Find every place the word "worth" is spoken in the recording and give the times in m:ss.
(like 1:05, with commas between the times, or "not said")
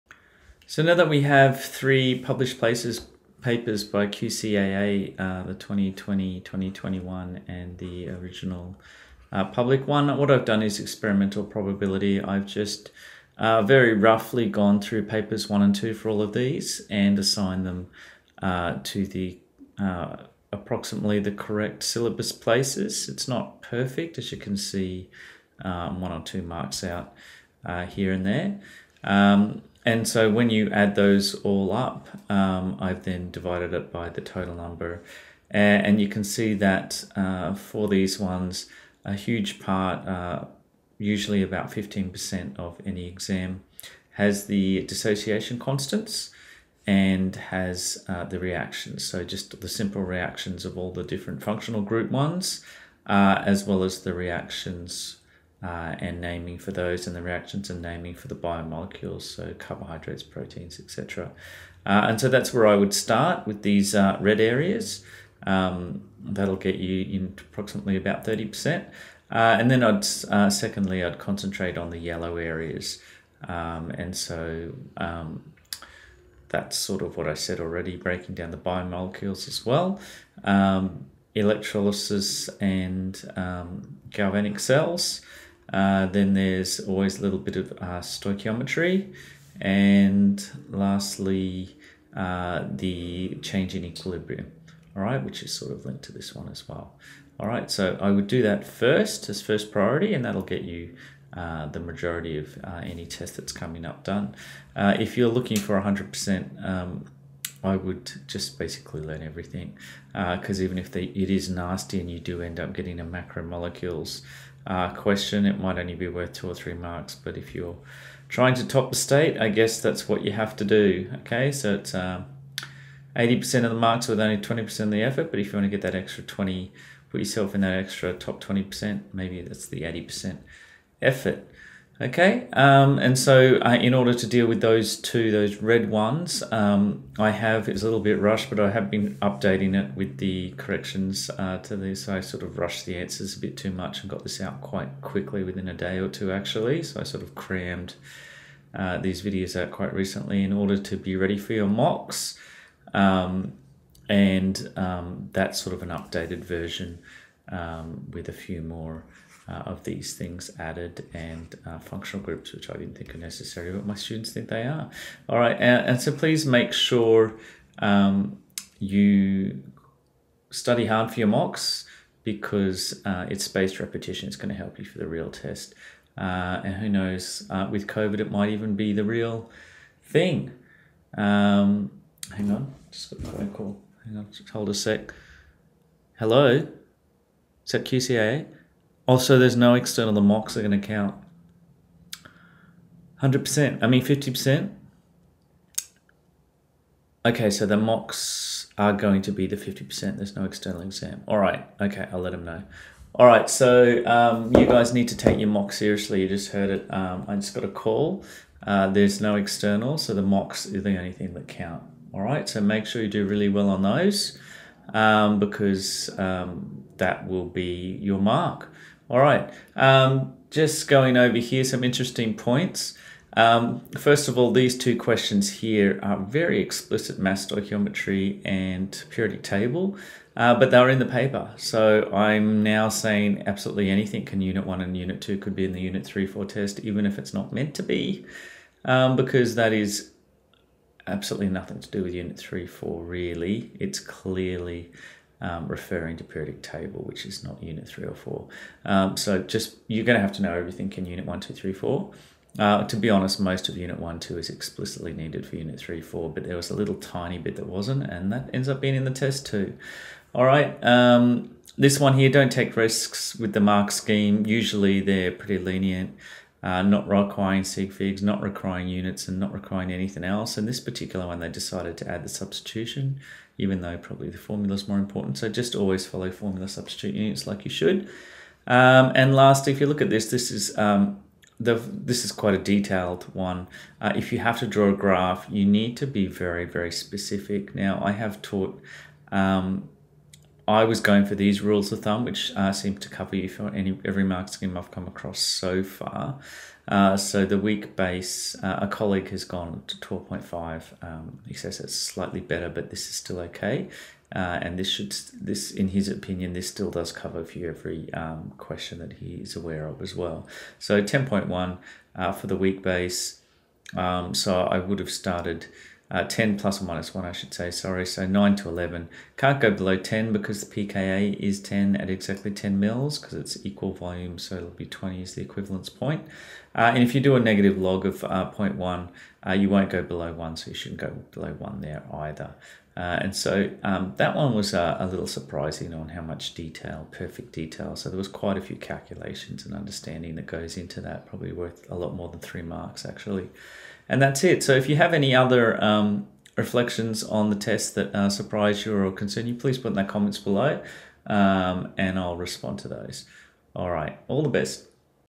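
1:56, 5:41.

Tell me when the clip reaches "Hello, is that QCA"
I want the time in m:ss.
3:06.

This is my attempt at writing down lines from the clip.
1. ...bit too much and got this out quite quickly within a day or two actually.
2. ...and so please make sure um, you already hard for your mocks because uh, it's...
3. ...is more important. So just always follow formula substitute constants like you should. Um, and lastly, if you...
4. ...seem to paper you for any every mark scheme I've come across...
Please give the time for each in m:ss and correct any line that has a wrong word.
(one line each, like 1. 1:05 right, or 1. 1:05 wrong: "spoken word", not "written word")
1. 2:23 right
2. 2:45 wrong: "study", not "already"
3. 4:34 wrong: "units", not "constants"
4. 4:52 wrong: "cover", not "paper".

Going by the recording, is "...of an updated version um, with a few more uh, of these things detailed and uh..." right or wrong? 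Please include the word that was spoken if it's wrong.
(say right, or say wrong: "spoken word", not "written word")
wrong: "added", not "detailed".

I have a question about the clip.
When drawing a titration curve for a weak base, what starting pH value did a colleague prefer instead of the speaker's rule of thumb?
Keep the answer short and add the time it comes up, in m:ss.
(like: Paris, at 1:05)
12.5, at 4:59.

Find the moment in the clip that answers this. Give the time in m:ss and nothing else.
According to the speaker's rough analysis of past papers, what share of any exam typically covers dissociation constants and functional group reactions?
0:41.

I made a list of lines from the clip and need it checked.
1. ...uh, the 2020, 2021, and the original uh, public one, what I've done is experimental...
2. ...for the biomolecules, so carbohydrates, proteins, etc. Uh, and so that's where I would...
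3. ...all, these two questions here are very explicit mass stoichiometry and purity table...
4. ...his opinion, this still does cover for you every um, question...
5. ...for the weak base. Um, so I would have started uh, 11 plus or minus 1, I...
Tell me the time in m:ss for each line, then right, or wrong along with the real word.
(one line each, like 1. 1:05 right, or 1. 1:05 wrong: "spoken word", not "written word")
1. 0:05 right
2. 0:58 right
3. 3:44 right
4. 5:05 right
5. 5:12 wrong: "10", not "11".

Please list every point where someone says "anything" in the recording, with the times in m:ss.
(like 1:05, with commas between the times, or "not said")
3:53, 4:29.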